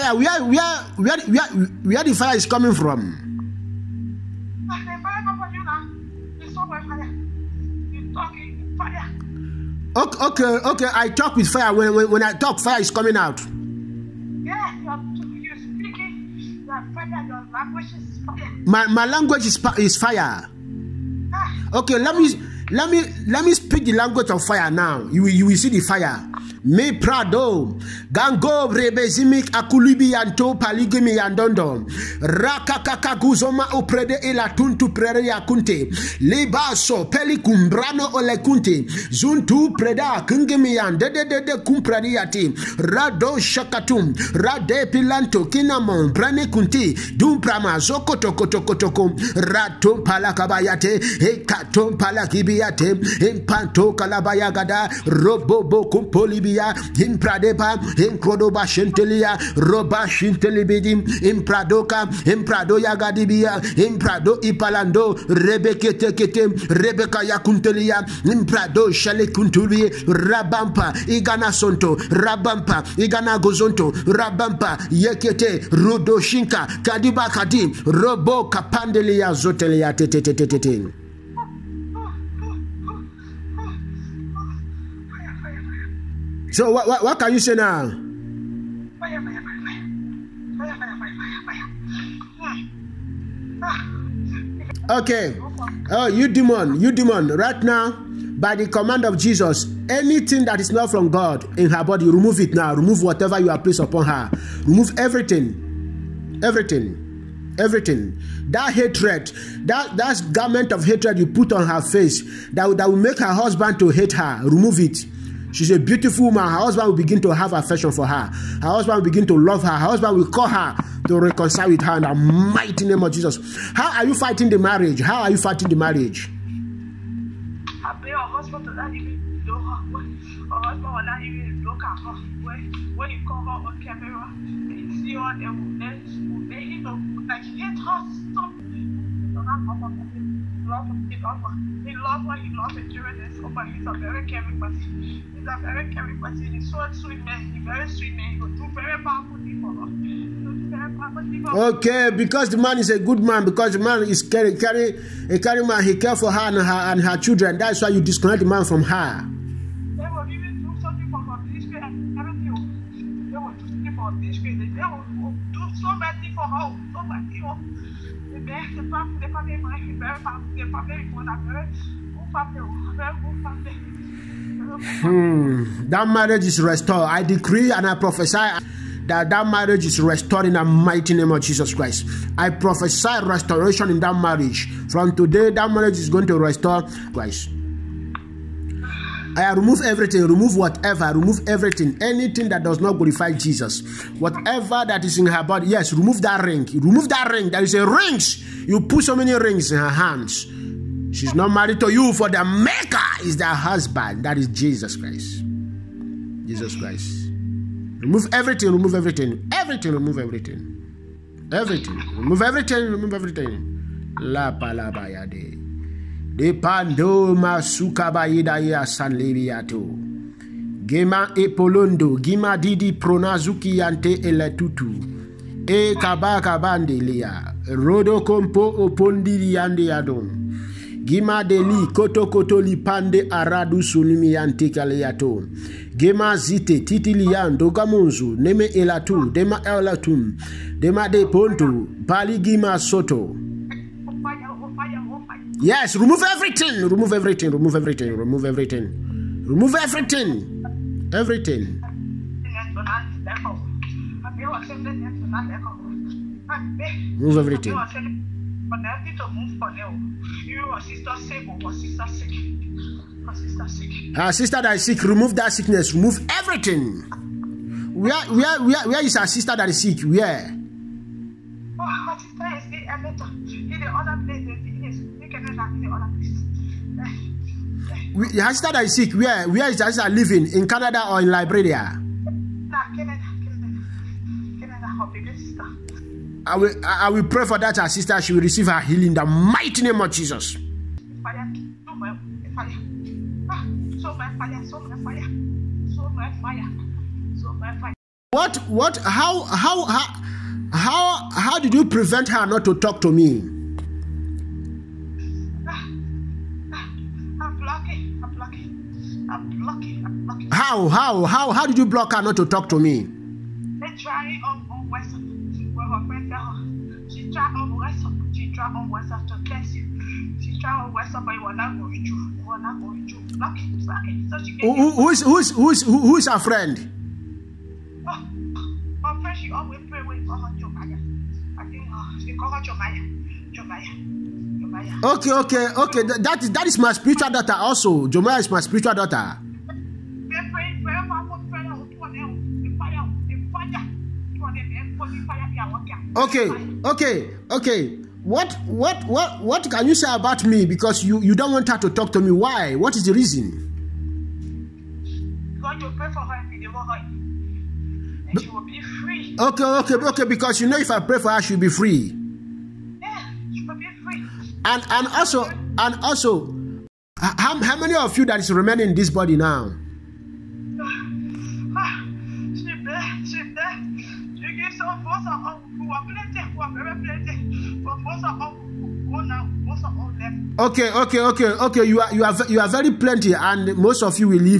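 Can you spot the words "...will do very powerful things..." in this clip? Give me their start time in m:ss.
2:28.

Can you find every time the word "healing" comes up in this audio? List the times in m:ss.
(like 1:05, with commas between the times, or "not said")
4:48.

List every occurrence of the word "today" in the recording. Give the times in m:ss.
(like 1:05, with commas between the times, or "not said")
3:05.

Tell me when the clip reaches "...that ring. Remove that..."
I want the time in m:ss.
3:16.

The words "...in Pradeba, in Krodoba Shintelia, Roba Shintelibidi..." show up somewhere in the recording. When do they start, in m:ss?
0:57.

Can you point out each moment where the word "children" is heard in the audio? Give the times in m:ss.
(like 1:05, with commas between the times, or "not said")
2:37.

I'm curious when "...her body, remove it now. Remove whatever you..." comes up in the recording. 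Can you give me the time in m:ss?
1:41.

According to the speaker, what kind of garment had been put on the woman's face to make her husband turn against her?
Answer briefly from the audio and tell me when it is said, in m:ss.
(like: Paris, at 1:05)
Garment of hatred, at 1:50.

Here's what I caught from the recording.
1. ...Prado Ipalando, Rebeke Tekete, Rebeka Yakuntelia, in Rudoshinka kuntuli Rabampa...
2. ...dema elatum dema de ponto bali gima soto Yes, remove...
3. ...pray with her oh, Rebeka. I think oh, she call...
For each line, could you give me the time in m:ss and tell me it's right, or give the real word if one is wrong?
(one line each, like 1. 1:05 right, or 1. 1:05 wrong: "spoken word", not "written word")
1. 1:03 wrong: "Prado", not "Rudoshinka"
2. 3:59 right
3. 5:29 wrong: "Jomaya", not "Rebeka".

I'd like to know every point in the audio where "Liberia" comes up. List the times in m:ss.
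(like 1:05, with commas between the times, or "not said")
4:41.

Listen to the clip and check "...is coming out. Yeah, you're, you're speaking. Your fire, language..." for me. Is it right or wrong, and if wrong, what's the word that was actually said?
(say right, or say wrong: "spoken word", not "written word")
right.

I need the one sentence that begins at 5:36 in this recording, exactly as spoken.
That is that is my spiritual daughter also.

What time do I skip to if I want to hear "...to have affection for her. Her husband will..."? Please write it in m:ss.
1:57.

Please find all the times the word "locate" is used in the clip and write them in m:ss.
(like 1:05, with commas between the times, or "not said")
not said.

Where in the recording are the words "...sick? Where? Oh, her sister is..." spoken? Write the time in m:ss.
4:29.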